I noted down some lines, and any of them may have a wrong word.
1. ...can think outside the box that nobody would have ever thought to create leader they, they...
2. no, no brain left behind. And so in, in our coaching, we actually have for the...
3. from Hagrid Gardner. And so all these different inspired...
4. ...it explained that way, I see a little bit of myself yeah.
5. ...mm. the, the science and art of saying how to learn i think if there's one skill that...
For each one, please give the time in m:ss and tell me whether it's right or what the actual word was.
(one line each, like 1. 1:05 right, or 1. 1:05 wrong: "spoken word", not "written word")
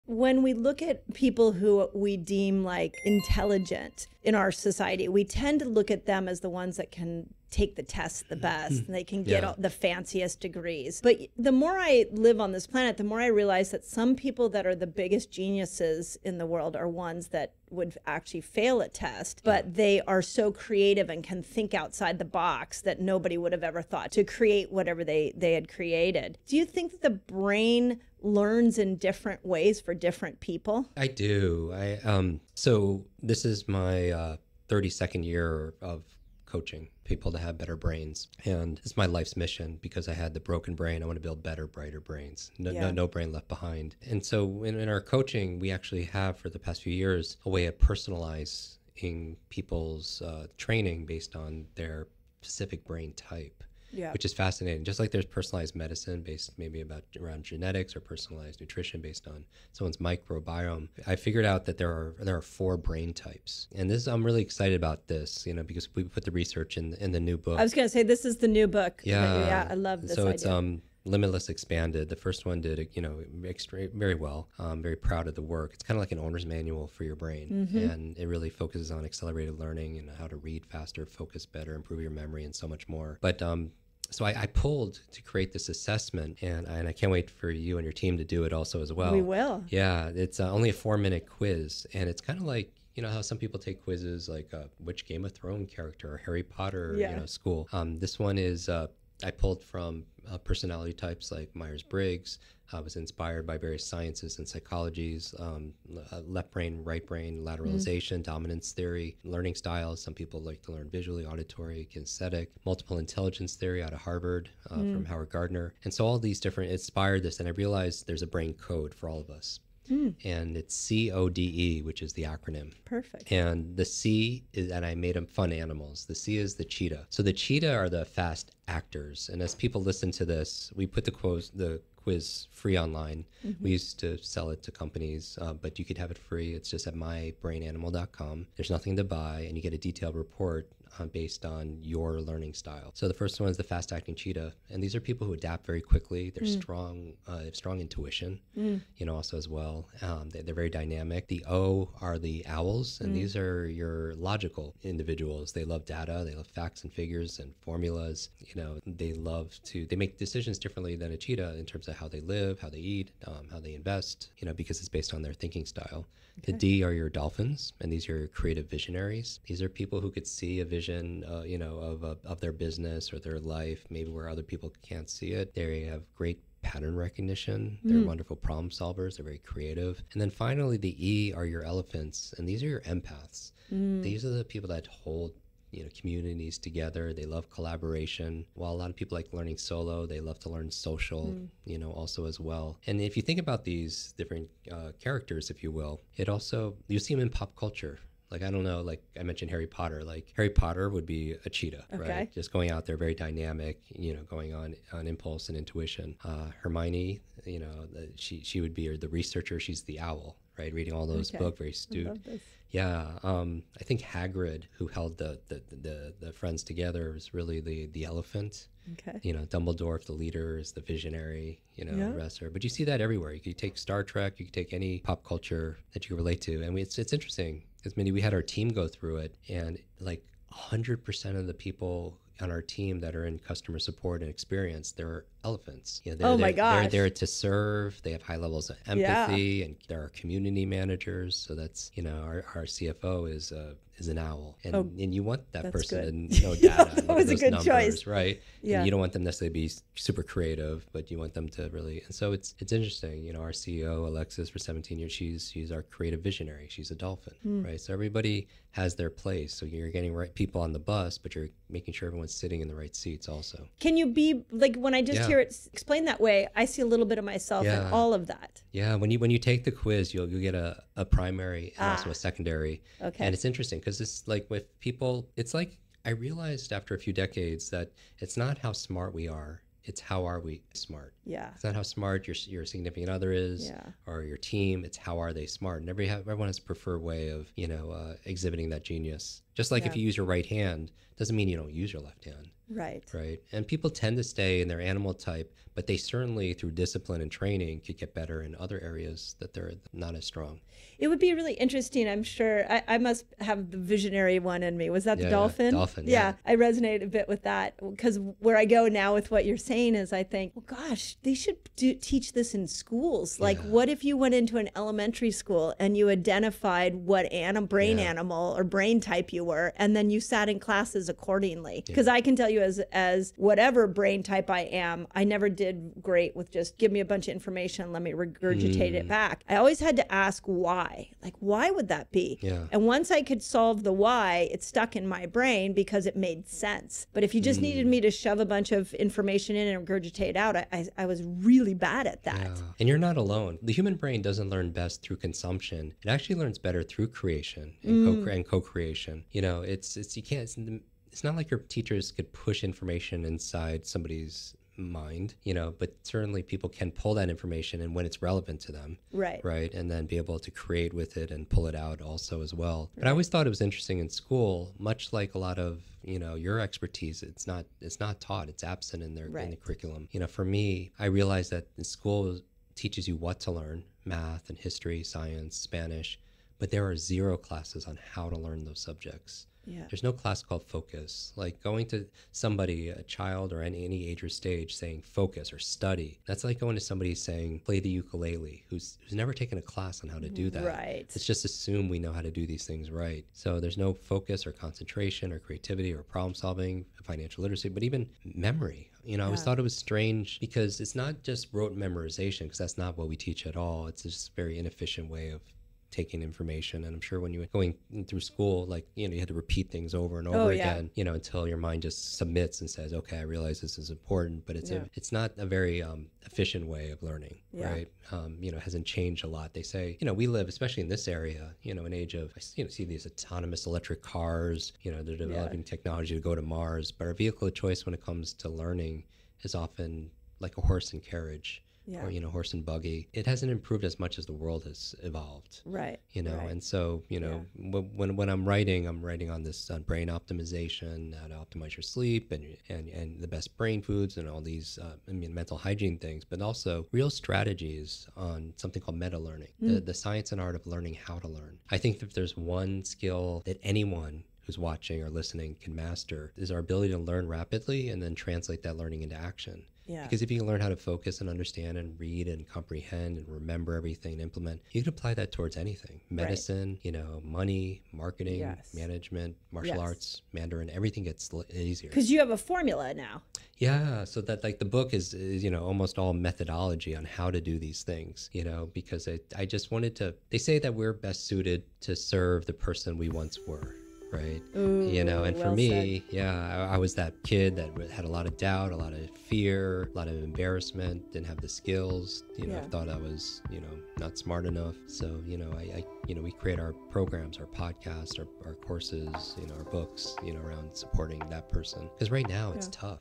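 1. 0:21 wrong: "whatever", not "leader"
2. 0:42 right
3. 1:54 wrong: "Howard", not "Hagrid"
4. 4:25 right
5. 7:29 wrong: "learning", not "saying".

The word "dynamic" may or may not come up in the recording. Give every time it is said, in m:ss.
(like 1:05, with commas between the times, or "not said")
2:30, 3:23.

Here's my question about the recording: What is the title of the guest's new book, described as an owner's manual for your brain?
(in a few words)
Limitless Expanded.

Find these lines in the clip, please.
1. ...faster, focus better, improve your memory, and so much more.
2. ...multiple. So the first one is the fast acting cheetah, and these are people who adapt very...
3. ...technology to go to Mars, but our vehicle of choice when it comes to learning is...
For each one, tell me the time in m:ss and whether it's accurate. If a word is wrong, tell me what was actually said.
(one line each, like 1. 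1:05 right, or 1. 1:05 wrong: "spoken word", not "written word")
1. 1:20 right
2. 2:22 wrong: "style", not "multiple"
3. 7:05 right.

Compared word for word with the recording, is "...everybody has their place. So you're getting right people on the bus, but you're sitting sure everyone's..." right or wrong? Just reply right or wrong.
wrong.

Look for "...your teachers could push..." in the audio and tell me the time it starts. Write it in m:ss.
5:51.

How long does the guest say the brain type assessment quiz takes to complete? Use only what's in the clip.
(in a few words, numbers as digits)
4 minutes.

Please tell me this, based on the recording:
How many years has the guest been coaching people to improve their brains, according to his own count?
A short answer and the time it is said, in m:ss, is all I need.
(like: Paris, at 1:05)
32, at 0:34.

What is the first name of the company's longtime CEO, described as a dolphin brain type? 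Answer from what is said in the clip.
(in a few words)
Alexis.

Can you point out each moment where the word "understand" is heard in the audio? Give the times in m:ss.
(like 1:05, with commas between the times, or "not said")
7:41.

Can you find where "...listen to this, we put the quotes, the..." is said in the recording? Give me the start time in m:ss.
2:09.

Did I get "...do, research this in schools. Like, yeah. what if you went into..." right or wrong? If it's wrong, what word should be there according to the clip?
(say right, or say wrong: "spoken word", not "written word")
wrong: "teach", not "research".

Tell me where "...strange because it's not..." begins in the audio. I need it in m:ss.
6:39.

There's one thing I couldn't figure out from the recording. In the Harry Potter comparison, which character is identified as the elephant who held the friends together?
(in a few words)
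Hagrid.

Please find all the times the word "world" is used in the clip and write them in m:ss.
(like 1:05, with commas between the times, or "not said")
0:16, 7:14.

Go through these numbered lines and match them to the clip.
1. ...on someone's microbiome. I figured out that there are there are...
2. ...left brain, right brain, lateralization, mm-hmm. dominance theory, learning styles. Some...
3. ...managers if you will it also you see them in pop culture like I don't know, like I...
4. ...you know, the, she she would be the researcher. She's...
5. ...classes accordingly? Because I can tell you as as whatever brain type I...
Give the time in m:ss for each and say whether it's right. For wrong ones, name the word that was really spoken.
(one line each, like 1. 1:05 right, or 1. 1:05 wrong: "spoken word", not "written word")
1. 0:59 right
2. 1:46 right
3. 3:14 wrong: "characters", not "managers"
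4. 3:27 right
5. 5:20 right.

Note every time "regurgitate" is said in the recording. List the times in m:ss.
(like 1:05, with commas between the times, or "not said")
5:28, 5:39.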